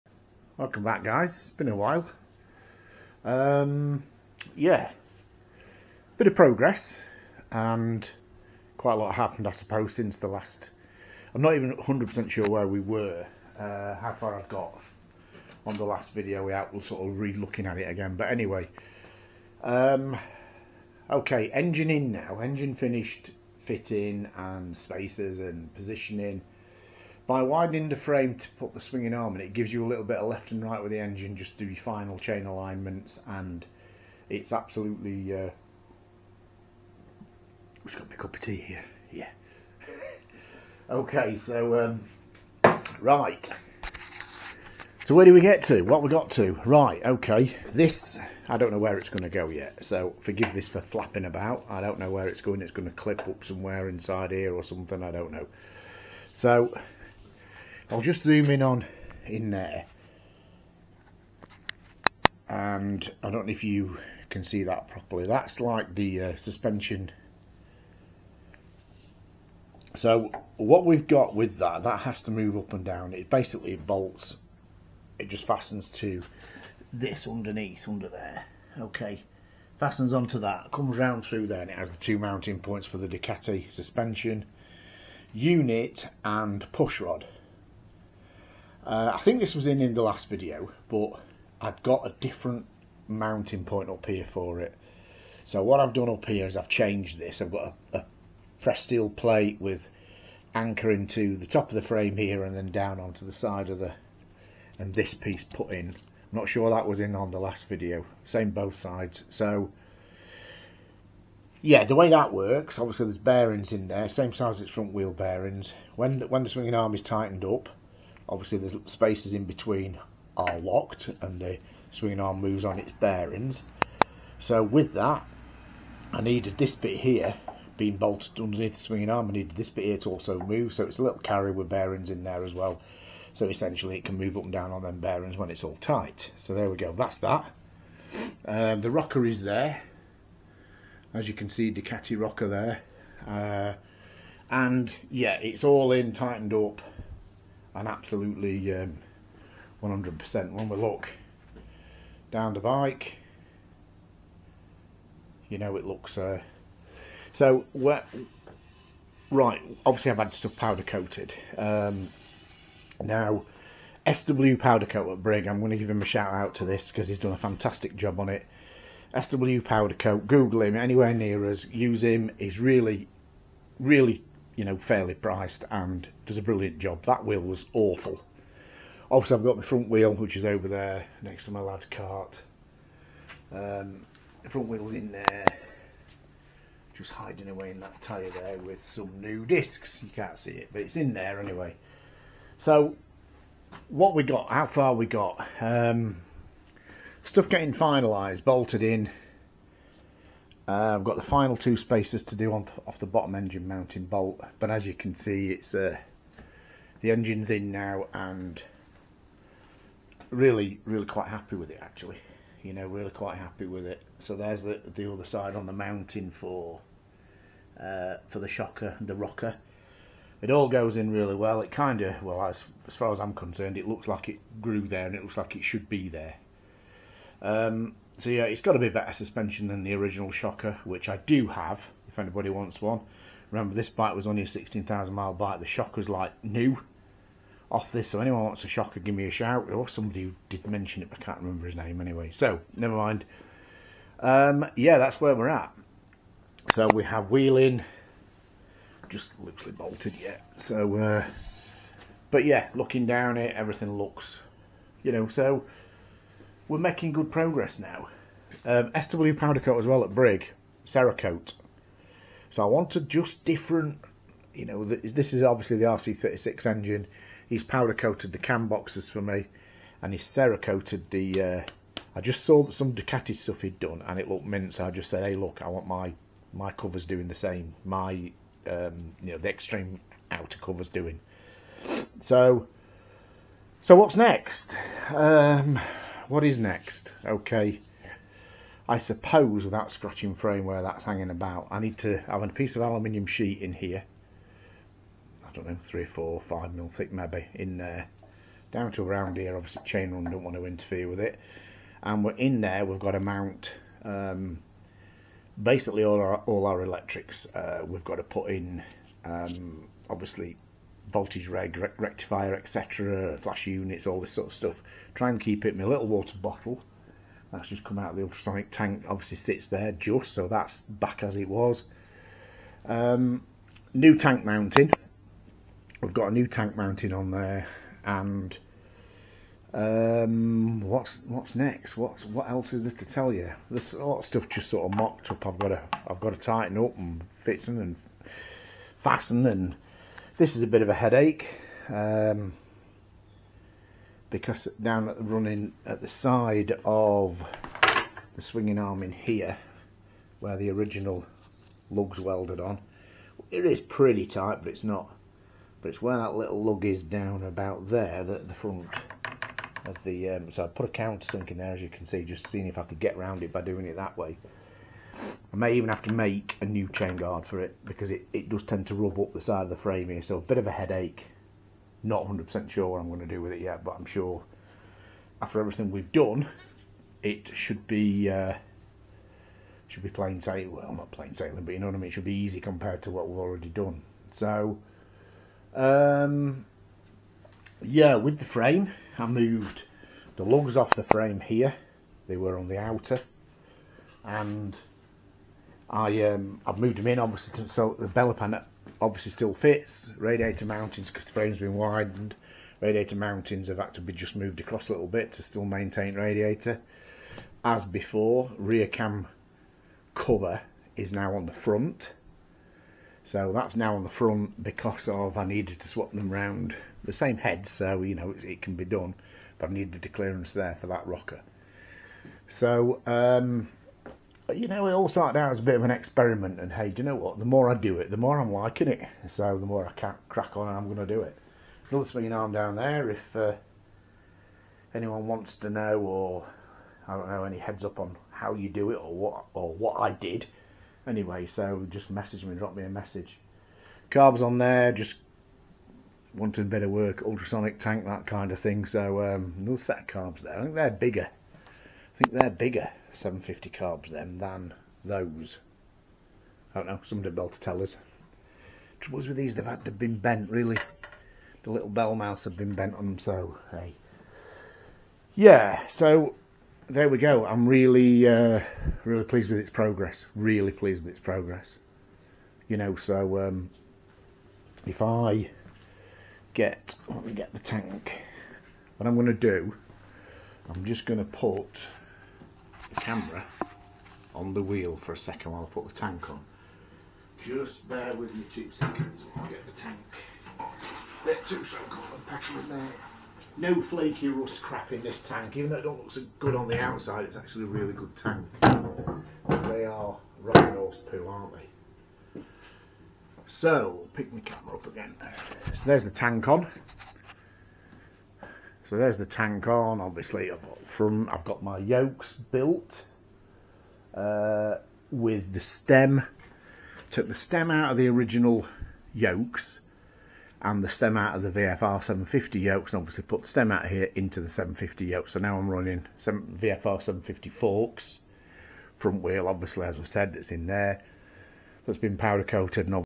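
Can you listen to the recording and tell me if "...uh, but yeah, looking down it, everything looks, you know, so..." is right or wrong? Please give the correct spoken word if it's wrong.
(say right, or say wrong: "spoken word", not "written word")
right.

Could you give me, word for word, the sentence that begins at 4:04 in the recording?
Um, yeah, that's where we're at.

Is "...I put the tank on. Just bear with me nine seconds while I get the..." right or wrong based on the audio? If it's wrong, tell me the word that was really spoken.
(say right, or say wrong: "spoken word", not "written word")
wrong: "two", not "nine".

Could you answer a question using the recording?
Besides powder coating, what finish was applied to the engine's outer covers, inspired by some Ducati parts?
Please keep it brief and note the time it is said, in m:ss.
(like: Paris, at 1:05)
Cerakote, at 4:30.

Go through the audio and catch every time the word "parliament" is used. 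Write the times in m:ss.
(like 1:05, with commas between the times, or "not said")
not said.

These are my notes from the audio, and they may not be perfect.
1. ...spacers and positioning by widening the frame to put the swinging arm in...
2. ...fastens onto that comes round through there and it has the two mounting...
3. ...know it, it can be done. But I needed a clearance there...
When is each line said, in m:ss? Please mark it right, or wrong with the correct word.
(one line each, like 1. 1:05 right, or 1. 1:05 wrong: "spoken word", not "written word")
1. 0:24 right
2. 1:19 right
3. 6:58 right.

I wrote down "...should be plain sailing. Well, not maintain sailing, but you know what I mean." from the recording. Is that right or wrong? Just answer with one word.
wrong.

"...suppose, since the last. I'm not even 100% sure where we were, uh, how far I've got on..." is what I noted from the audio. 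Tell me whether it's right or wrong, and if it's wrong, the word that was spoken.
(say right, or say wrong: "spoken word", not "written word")
right.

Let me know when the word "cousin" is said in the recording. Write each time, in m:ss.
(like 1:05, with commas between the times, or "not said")
not said.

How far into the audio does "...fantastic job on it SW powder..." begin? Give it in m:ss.
2:47.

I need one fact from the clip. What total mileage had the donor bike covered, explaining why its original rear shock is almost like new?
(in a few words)
16,000 miles.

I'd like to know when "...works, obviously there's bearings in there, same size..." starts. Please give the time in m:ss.
1:52.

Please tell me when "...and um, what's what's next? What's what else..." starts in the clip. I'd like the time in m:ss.
5:28.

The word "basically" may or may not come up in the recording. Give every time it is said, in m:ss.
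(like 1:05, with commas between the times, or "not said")
1:13, 5:05.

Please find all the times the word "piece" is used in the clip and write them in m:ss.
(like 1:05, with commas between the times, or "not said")
1:45, 4:52.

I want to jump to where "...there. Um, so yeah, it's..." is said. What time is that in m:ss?
3:46.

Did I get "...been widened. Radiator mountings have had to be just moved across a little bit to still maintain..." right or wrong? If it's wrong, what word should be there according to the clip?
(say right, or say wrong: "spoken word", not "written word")
right.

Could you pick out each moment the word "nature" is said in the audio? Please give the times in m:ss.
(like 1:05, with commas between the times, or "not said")
not said.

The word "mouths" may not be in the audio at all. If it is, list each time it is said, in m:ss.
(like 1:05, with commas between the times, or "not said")
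7:42.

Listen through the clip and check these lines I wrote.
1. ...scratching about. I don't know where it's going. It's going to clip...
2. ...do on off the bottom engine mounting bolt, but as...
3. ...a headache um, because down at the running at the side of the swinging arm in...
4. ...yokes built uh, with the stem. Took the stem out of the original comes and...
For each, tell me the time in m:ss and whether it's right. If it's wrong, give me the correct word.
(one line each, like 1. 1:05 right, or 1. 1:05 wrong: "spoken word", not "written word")
1. 0:50 wrong: "flapping", not "scratching"
2. 3:22 right
3. 5:40 right
4. 8:31 wrong: "yokes", not "comes".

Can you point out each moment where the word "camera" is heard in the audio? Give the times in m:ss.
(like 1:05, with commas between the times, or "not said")
8:02, 8:24.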